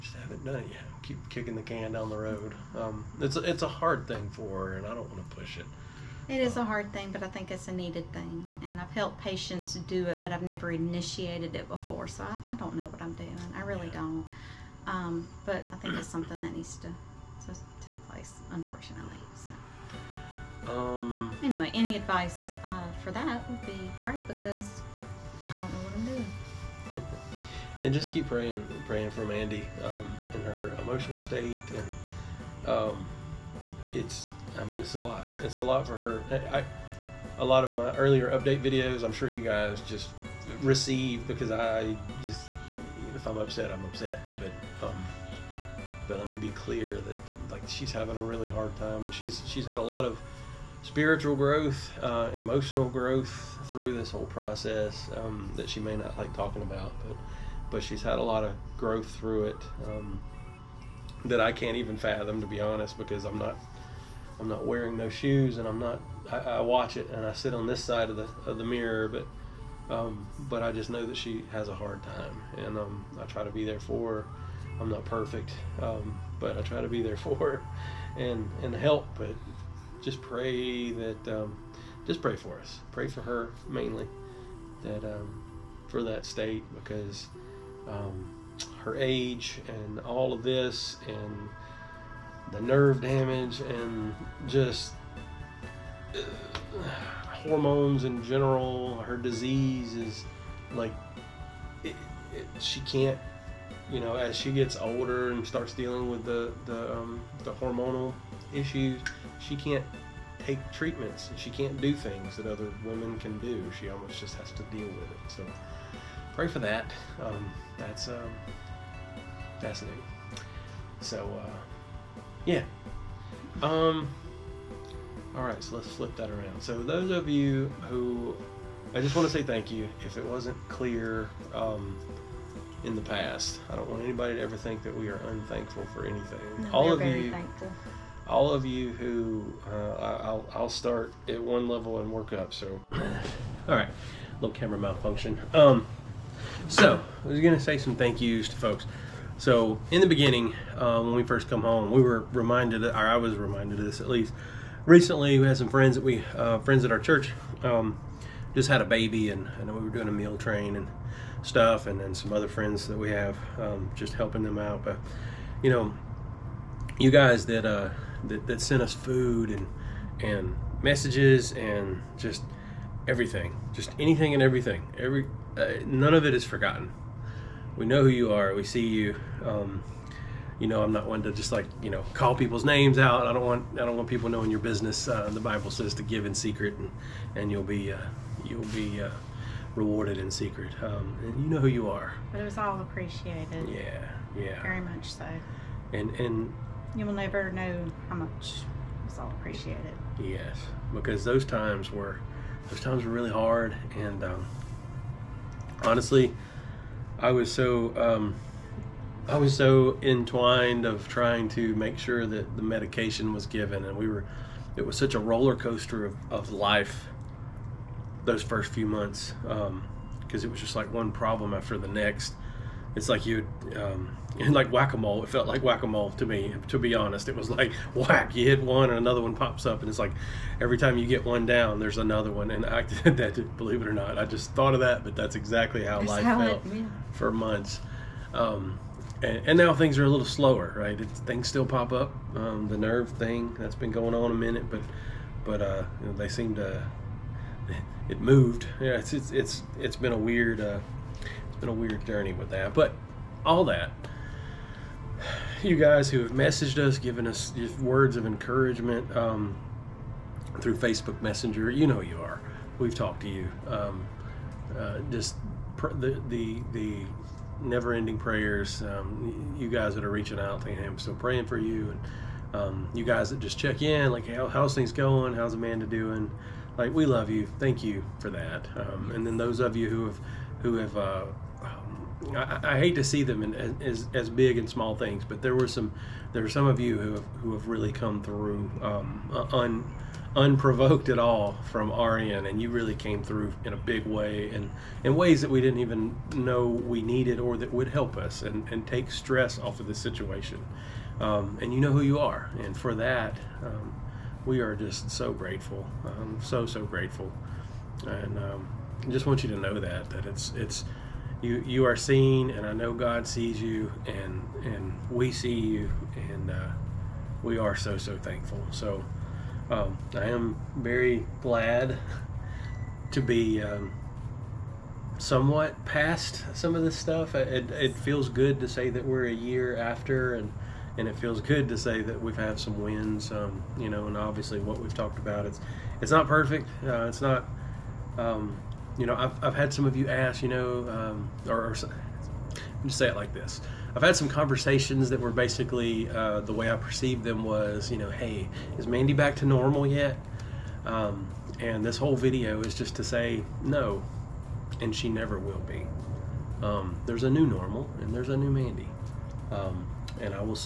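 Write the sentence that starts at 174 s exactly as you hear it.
Every uh, none of it is forgotten.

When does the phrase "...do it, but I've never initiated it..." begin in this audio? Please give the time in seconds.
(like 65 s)
9 s.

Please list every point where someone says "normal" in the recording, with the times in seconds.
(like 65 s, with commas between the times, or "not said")
349 s, 357 s.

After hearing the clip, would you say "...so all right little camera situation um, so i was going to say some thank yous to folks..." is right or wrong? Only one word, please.
wrong.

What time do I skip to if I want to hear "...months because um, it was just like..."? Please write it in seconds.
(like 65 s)
218 s.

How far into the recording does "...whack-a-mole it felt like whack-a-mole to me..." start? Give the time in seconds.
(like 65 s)
224 s.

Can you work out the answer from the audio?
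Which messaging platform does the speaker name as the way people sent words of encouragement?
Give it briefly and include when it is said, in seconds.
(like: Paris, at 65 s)
Facebook Messenger, at 260 s.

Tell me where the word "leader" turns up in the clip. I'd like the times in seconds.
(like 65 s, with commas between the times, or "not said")
not said.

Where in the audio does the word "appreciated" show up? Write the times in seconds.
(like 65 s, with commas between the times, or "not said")
192 s, 199 s.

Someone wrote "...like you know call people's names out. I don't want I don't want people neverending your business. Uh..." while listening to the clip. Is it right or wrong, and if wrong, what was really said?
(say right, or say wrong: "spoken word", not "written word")
wrong: "knowing", not "neverending".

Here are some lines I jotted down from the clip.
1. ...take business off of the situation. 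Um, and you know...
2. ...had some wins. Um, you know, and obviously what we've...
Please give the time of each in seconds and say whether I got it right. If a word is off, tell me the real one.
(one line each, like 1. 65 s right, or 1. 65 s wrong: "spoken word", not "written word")
1. 298 s wrong: "stress", not "business"
2. 332 s right.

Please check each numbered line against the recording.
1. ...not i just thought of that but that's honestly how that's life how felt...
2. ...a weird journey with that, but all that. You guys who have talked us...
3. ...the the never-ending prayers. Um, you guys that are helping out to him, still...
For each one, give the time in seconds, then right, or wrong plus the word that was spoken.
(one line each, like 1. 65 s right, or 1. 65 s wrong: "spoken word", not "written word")
1. 233 s wrong: "exactly", not "honestly"
2. 251 s wrong: "messaged", not "talked"
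3. 266 s wrong: "reaching", not "helping".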